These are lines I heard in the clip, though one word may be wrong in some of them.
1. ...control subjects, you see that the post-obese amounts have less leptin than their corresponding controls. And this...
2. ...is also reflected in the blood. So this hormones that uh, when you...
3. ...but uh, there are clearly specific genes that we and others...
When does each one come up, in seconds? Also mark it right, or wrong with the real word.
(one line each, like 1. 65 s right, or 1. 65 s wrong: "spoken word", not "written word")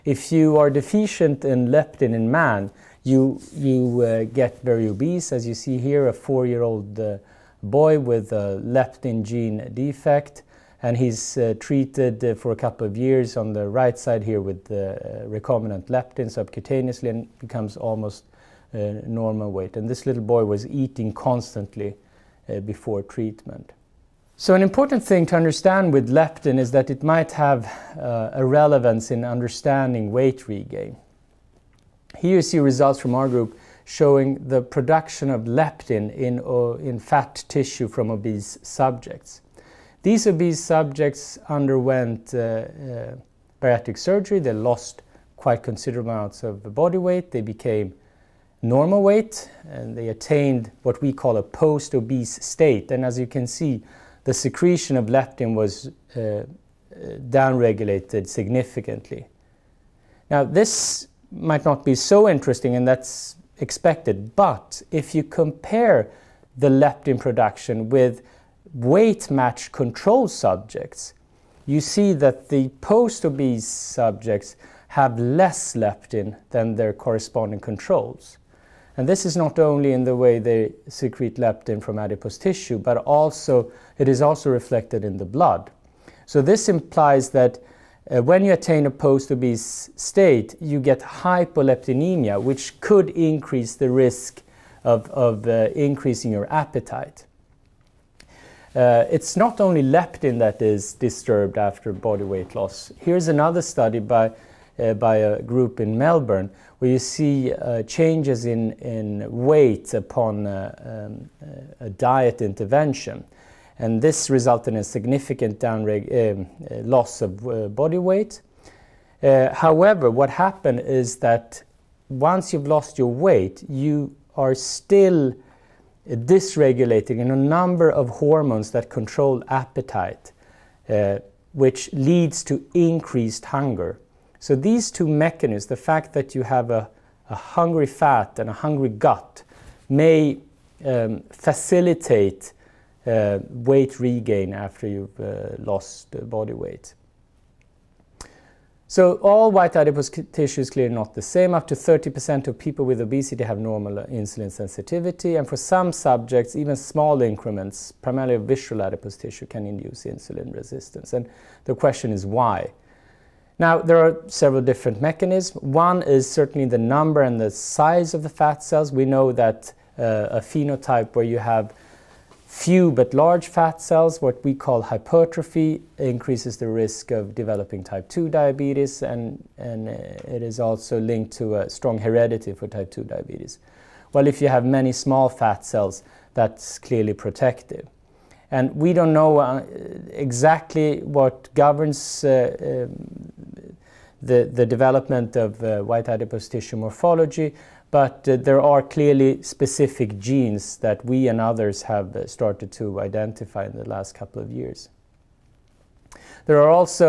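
1. 69 s wrong: "subjects", not "amounts"
2. 84 s wrong: "implies", not "hormones"
3. 197 s right.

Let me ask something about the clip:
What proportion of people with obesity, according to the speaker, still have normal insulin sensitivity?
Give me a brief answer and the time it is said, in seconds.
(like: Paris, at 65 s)
Up to 30%, at 151 s.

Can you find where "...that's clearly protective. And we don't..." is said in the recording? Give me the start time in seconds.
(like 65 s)
186 s.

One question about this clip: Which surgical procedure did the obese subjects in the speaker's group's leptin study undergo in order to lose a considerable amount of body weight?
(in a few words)
Bariatric surgery.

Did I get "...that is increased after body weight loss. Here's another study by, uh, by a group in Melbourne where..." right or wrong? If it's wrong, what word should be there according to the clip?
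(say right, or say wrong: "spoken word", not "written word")
wrong: "disturbed", not "increased".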